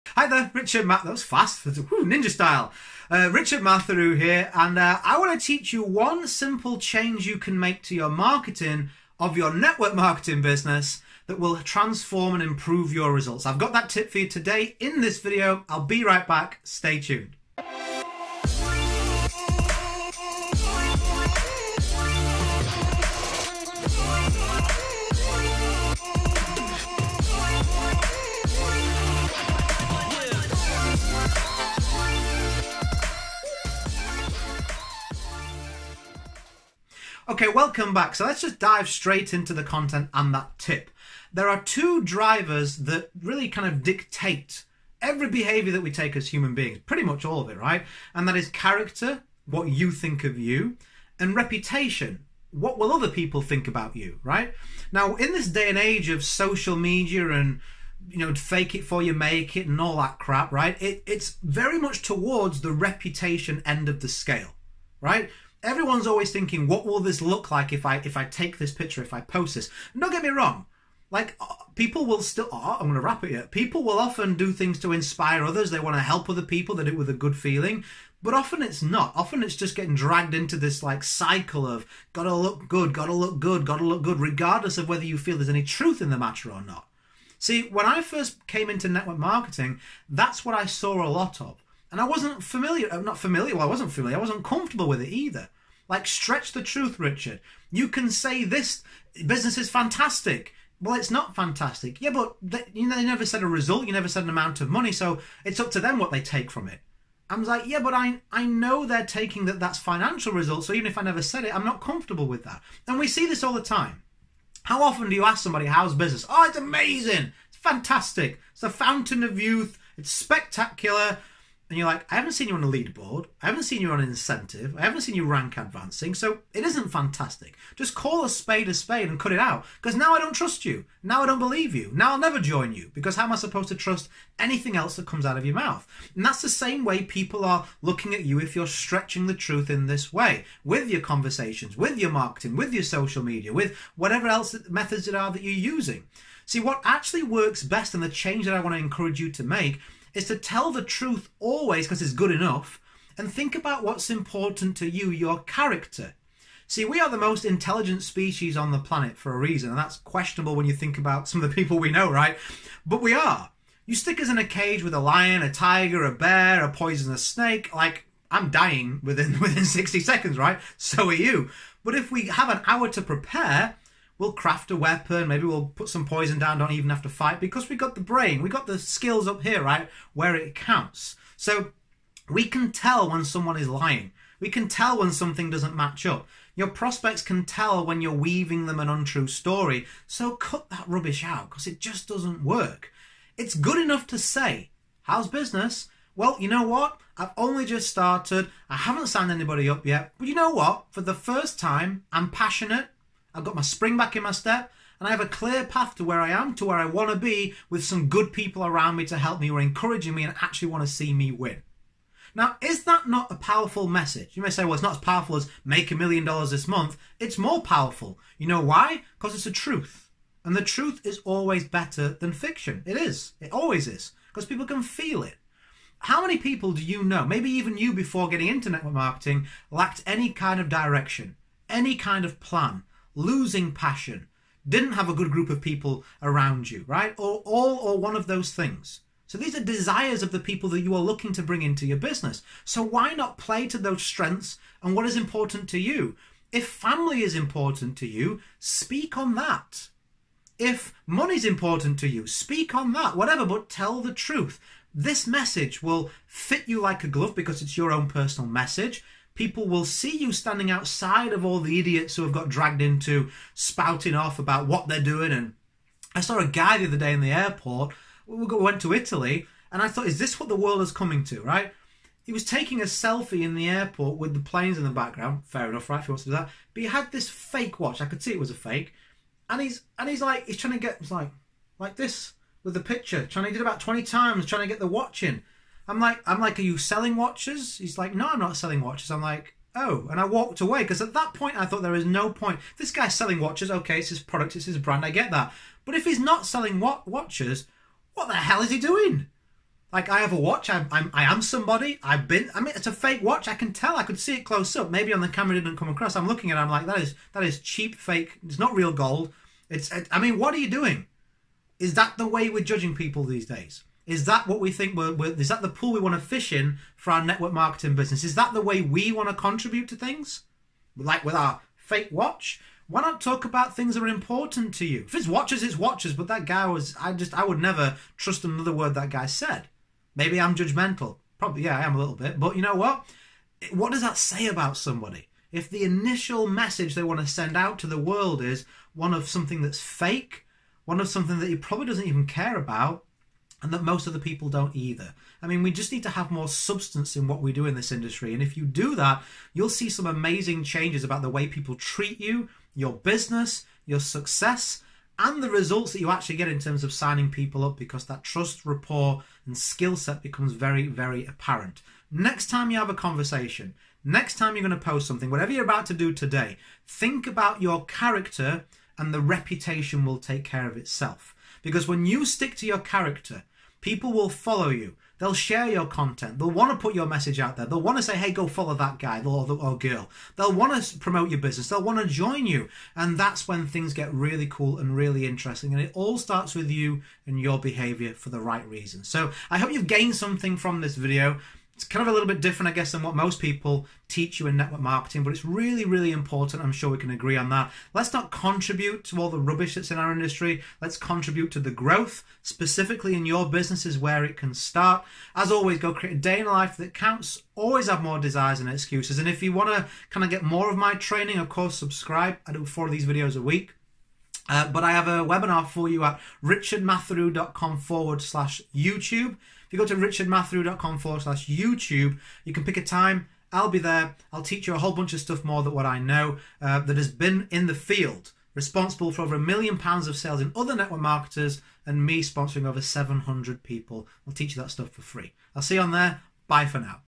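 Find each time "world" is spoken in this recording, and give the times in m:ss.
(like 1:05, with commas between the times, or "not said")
4:30, 5:37.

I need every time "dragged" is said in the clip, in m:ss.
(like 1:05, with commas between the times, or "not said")
1:19, 4:22.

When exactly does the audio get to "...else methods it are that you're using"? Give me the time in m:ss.
2:24.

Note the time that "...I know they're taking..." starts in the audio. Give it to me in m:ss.
1:48.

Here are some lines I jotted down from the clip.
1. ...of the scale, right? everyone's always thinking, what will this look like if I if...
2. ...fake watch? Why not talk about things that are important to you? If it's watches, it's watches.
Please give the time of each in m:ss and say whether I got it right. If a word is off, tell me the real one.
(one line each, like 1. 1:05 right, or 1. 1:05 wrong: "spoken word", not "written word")
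1. 1:03 right
2. 5:21 right.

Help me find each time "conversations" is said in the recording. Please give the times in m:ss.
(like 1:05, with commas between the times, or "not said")
2:20, 6:02.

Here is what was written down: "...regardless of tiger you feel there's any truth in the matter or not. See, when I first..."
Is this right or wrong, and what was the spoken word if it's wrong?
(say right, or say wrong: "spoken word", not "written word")
wrong: "whether", not "tiger".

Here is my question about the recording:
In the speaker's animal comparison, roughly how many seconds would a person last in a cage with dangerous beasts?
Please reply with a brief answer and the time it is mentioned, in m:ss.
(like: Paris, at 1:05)
60 seconds, at 2:49.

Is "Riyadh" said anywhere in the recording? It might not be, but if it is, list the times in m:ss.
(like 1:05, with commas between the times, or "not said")
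not said.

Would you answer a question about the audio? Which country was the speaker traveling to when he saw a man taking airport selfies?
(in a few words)
Italy.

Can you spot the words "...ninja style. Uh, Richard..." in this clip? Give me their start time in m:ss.
0:02.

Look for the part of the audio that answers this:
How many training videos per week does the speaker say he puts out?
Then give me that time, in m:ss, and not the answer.
6:52.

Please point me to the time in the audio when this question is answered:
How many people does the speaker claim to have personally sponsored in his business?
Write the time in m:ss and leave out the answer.
7:12.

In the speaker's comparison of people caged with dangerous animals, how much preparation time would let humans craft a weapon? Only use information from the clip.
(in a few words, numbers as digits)
An hour.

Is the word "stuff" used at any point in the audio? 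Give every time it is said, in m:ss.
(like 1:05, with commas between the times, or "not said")
7:05, 7:14.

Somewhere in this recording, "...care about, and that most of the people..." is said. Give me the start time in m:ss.
5:42.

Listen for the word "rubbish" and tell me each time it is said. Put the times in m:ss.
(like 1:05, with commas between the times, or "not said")
3:10, 6:39.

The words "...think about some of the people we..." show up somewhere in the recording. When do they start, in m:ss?
2:40.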